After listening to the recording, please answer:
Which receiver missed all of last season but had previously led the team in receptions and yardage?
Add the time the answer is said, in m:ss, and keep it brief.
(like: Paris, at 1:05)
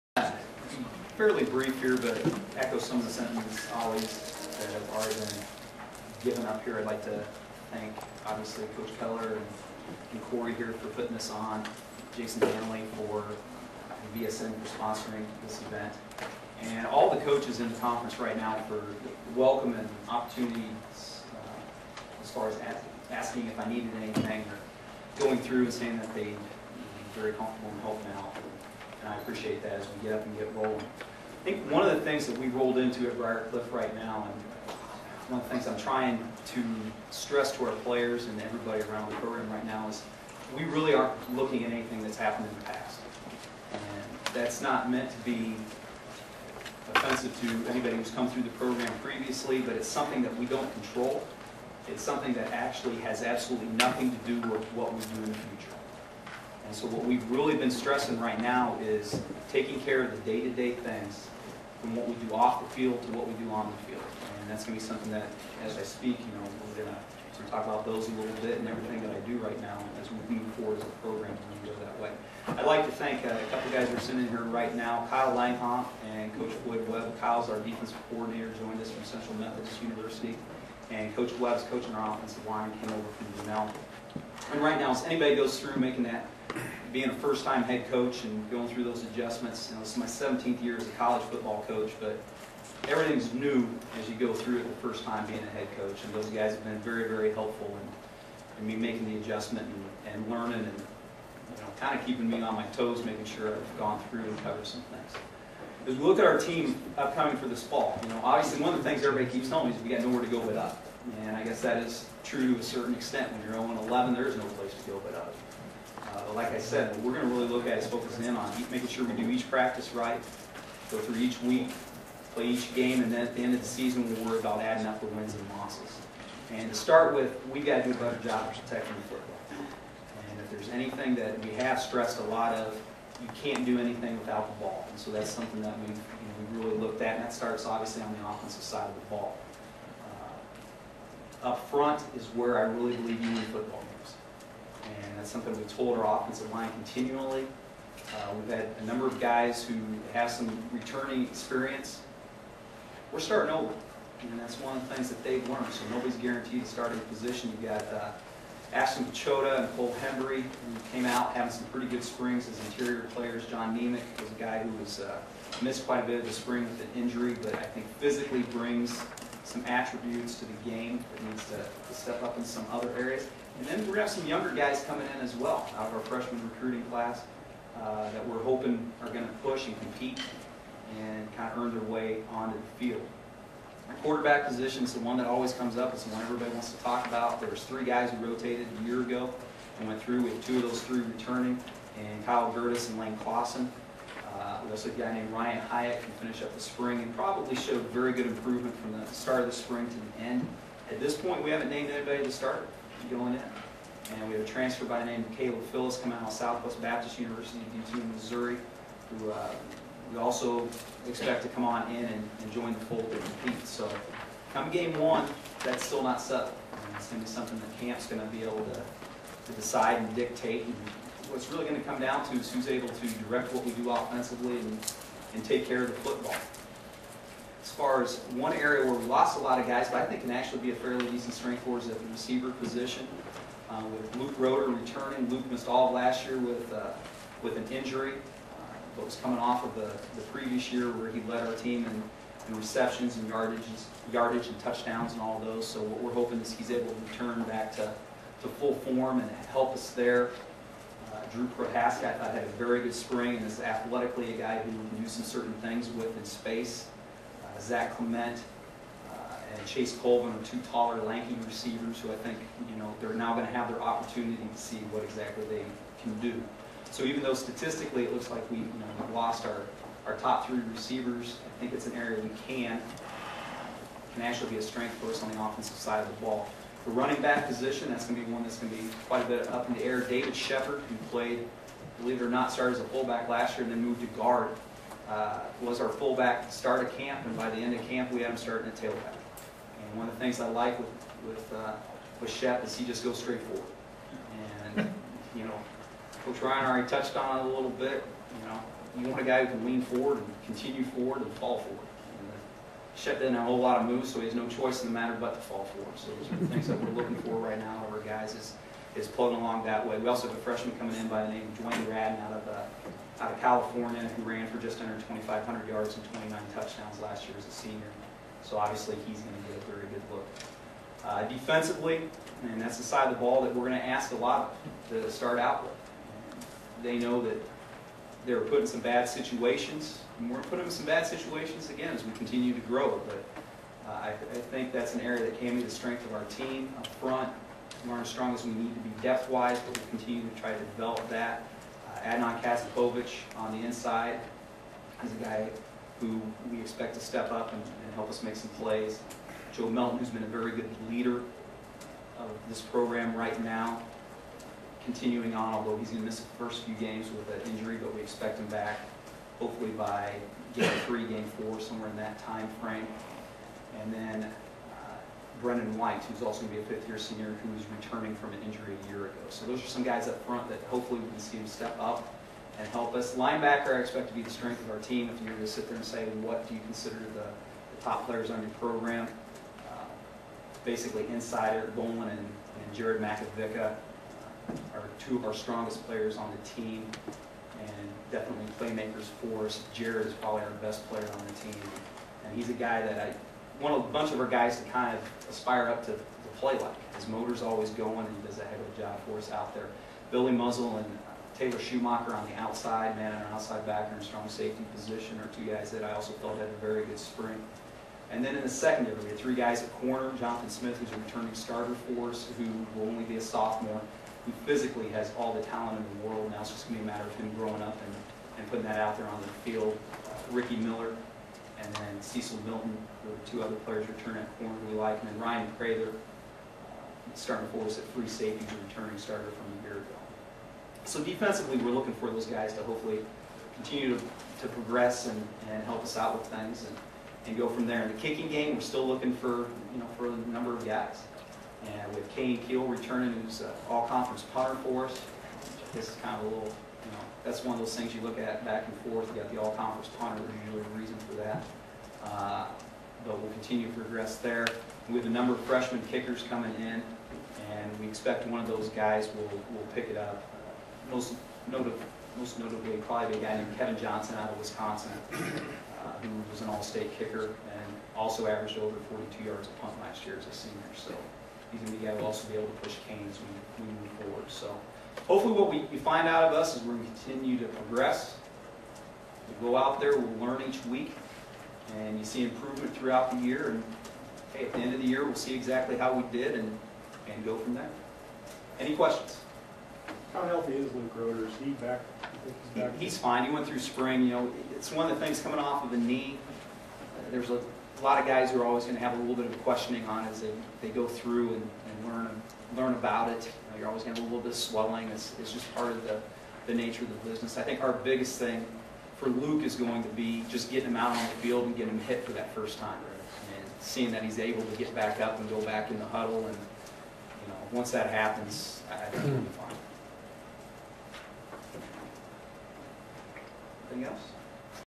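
Luke Roeder, at 3:54.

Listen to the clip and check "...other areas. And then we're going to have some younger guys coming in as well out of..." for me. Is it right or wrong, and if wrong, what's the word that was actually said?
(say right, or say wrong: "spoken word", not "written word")
right.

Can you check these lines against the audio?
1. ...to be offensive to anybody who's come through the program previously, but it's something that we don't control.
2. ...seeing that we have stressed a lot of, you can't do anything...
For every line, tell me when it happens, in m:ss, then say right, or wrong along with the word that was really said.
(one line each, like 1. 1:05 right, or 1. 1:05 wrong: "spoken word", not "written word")
1. 0:45 right
2. 2:10 wrong: "anything", not "seeing".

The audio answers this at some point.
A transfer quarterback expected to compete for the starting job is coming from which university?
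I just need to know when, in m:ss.
3:26.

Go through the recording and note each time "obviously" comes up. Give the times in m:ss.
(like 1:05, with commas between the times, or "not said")
0:08, 1:48, 2:17, 5:18.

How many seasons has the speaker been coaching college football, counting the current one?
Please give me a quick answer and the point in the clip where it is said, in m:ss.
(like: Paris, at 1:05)
17, at 1:30.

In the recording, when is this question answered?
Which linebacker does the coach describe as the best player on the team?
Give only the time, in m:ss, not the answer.
6:22.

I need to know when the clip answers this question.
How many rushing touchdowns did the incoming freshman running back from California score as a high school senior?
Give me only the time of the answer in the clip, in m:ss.
5:16.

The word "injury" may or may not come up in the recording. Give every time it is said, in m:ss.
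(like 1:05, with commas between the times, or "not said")
2:47, 3:57, 5:57, 6:08.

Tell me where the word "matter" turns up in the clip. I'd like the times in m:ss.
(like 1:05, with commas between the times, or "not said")
5:04, 6:56.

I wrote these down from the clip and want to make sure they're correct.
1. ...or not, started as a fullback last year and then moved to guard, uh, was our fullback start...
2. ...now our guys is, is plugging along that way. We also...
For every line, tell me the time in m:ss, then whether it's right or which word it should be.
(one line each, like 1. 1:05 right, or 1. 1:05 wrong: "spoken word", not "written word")
1. 4:42 right
2. 5:07 right.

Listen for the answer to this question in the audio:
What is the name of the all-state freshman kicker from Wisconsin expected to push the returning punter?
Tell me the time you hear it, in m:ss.
7:43.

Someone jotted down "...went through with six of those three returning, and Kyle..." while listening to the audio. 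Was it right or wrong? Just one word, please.
wrong.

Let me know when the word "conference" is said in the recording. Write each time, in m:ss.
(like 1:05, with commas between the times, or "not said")
0:17, 7:23, 7:29.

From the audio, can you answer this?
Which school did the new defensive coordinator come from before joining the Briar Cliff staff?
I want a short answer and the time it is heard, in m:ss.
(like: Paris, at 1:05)
Central Methodist University, at 1:19.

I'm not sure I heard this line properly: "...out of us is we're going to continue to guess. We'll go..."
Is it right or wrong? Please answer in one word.
wrong.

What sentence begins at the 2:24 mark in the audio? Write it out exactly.
And that's something we told our offensive line continually.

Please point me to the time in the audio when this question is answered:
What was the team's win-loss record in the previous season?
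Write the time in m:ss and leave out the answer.
1:53.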